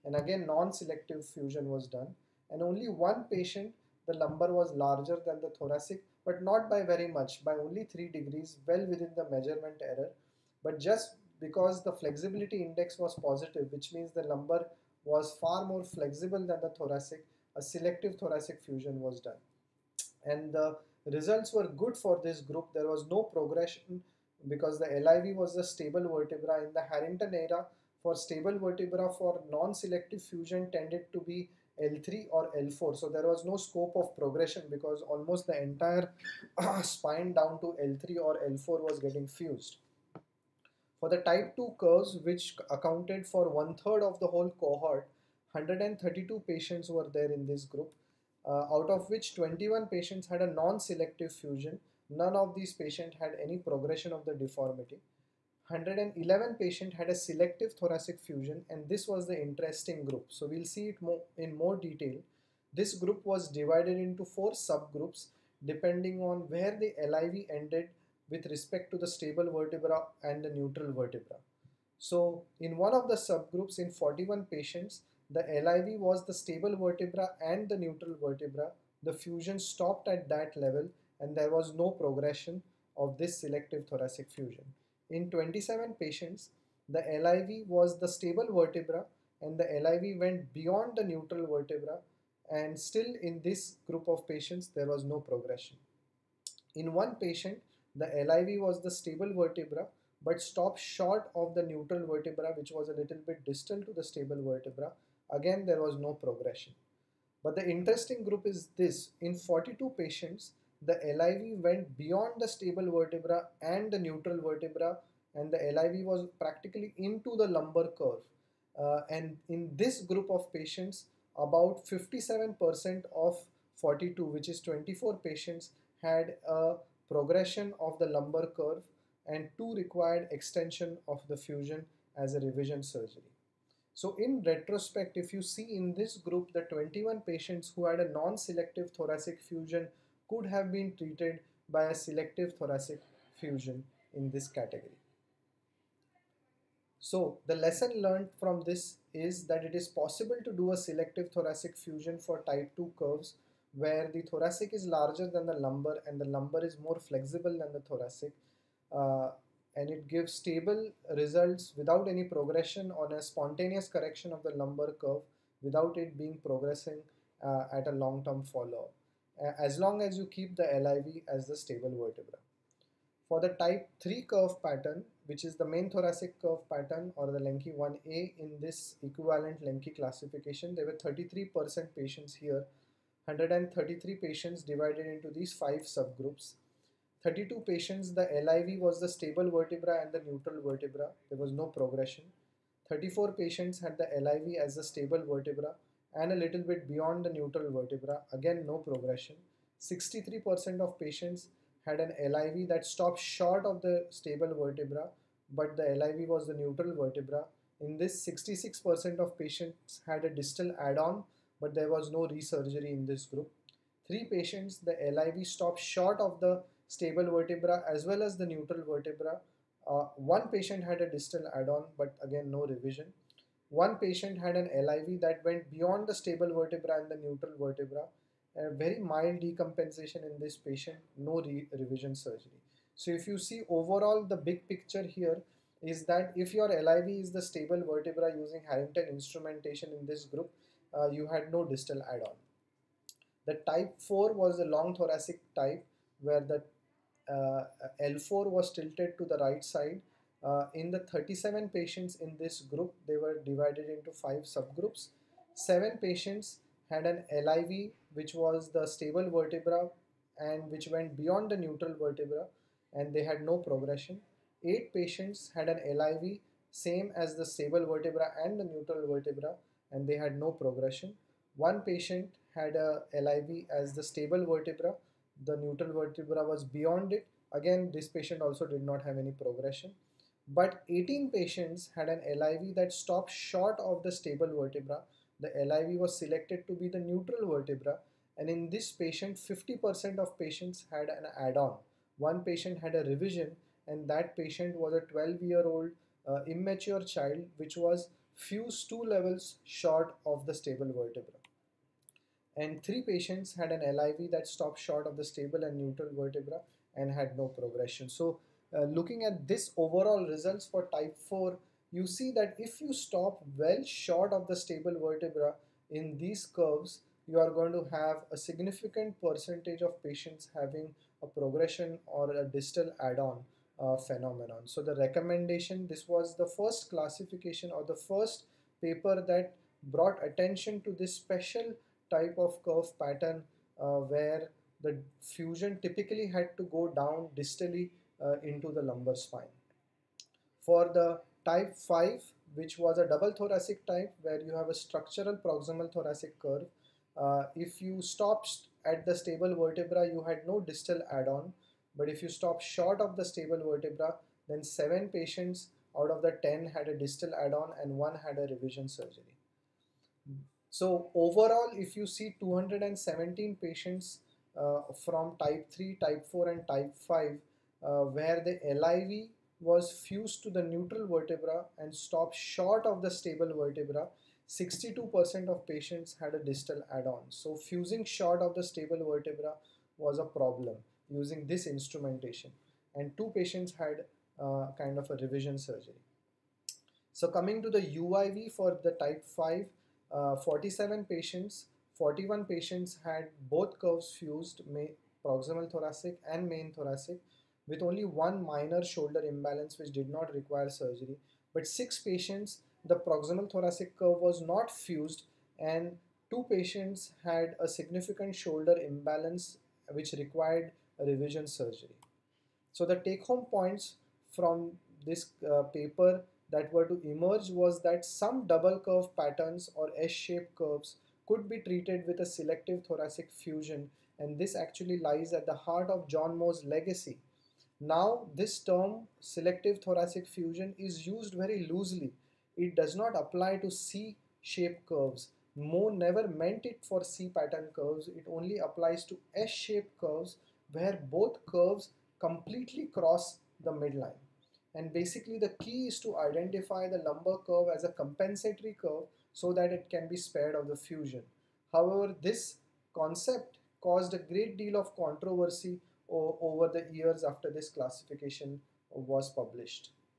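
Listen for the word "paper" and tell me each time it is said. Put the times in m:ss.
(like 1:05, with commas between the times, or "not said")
5:28, 6:55.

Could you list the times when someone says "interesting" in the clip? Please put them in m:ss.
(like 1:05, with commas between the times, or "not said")
0:59, 1:47.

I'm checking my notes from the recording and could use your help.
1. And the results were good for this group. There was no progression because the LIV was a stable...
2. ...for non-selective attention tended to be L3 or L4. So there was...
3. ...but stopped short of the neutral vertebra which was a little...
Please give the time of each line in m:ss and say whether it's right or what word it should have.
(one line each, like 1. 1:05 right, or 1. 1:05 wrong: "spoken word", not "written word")
1. 0:20 right
2. 0:29 wrong: "fusion", not "attention"
3. 1:40 right.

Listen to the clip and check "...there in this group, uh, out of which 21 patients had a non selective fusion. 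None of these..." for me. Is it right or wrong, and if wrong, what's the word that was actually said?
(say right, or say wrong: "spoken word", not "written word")
right.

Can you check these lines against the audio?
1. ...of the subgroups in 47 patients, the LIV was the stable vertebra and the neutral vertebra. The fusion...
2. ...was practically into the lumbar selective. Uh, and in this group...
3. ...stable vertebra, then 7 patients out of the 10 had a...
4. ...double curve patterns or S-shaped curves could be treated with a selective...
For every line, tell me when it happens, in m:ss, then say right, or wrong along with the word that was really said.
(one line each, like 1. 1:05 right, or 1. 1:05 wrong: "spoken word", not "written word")
1. 1:12 wrong: "41", not "47"
2. 1:56 wrong: "curve", not "selective"
3. 5:53 right
4. 6:58 right.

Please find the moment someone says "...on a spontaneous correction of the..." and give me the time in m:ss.
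2:42.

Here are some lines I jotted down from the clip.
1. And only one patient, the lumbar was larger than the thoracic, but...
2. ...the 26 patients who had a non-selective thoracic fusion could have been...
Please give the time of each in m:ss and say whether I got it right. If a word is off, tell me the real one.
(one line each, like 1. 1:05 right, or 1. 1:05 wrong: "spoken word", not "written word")
1. 0:02 right
2. 2:16 wrong: "21", not "26".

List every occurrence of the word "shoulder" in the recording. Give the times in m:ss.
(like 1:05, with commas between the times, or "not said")
6:38, 6:48.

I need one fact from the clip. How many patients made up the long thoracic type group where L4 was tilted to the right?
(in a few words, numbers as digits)
37.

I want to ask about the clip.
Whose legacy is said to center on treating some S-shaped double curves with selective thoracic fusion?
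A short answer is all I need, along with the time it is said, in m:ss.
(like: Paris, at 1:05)
John Moe, at 7:06.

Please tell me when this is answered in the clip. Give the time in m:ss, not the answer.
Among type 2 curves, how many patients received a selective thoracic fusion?
0:55.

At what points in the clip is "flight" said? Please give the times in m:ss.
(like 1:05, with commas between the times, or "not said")
not said.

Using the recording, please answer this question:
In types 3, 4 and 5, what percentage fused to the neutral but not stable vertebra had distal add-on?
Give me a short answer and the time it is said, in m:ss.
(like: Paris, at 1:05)
62%, at 6:14.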